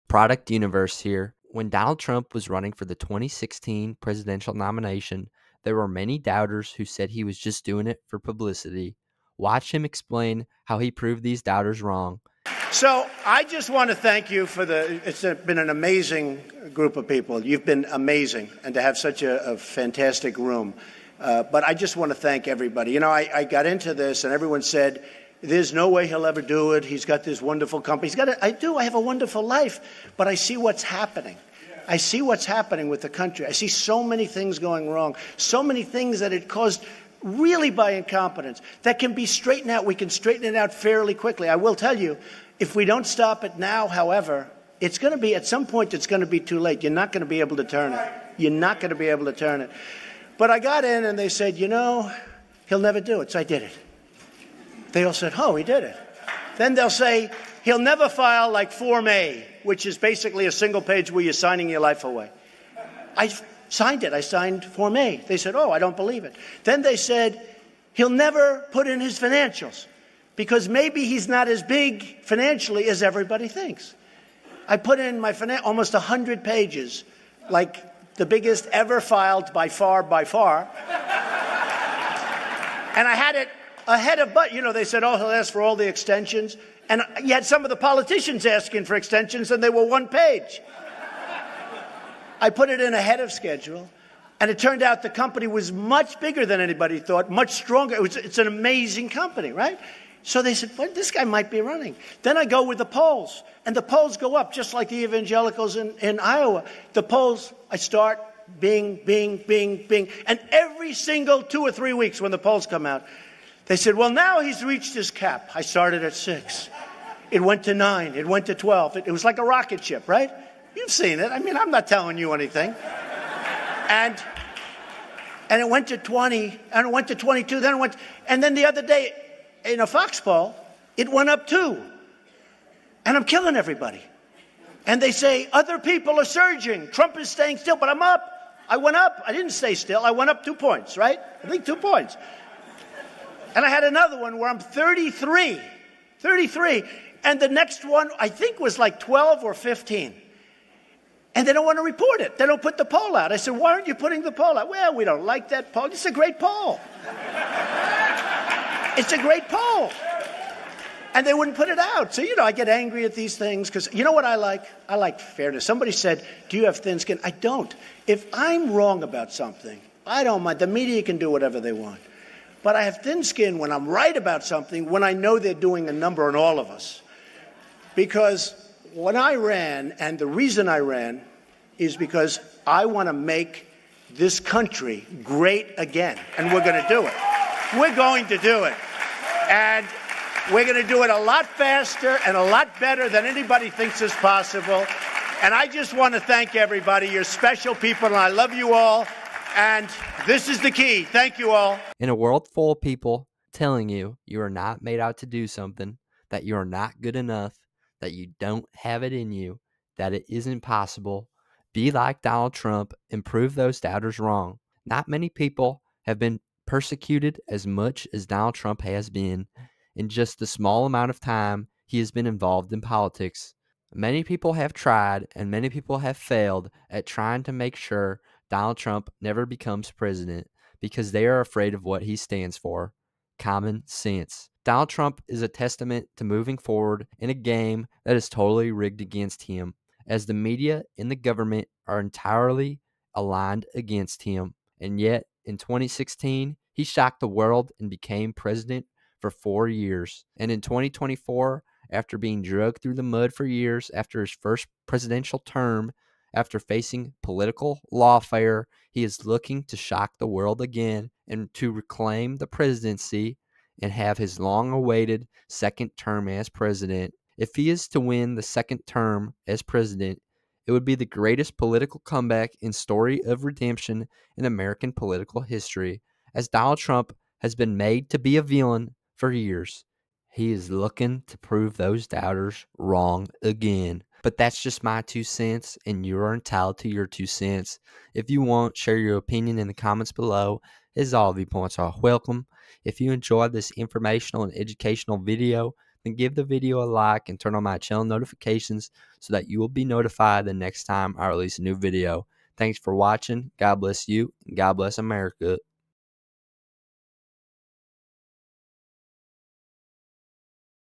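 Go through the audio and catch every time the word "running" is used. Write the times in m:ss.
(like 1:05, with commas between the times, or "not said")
0:02, 1:41.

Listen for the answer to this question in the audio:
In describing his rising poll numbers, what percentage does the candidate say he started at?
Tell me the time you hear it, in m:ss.
1:56.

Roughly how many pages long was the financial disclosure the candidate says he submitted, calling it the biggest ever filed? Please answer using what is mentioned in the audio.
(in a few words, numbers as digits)
100.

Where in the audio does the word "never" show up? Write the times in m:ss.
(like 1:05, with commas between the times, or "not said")
0:52, 0:57, 1:08, 3:49.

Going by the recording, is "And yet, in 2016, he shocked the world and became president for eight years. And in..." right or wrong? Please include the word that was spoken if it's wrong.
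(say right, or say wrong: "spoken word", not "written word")
wrong: "four", not "eight".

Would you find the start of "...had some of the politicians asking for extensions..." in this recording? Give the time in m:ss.
1:27.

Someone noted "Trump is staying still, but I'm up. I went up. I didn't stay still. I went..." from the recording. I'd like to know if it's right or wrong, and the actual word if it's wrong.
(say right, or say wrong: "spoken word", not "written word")
right.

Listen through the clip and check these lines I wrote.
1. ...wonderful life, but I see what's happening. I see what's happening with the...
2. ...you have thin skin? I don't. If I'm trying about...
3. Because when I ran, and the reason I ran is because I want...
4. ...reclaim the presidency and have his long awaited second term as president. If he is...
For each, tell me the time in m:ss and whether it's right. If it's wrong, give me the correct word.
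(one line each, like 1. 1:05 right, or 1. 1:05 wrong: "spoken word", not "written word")
1. 0:28 right
2. 2:46 wrong: "wrong", not "trying"
3. 2:57 right
4. 4:21 right.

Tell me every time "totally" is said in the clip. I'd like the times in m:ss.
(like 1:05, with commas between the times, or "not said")
3:58.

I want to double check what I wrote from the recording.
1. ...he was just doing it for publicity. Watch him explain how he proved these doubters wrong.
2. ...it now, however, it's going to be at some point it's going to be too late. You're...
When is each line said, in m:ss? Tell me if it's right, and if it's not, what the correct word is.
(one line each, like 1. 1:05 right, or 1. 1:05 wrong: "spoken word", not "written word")
1. 0:07 right
2. 0:43 right.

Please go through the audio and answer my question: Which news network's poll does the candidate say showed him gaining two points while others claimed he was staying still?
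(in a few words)
Fox.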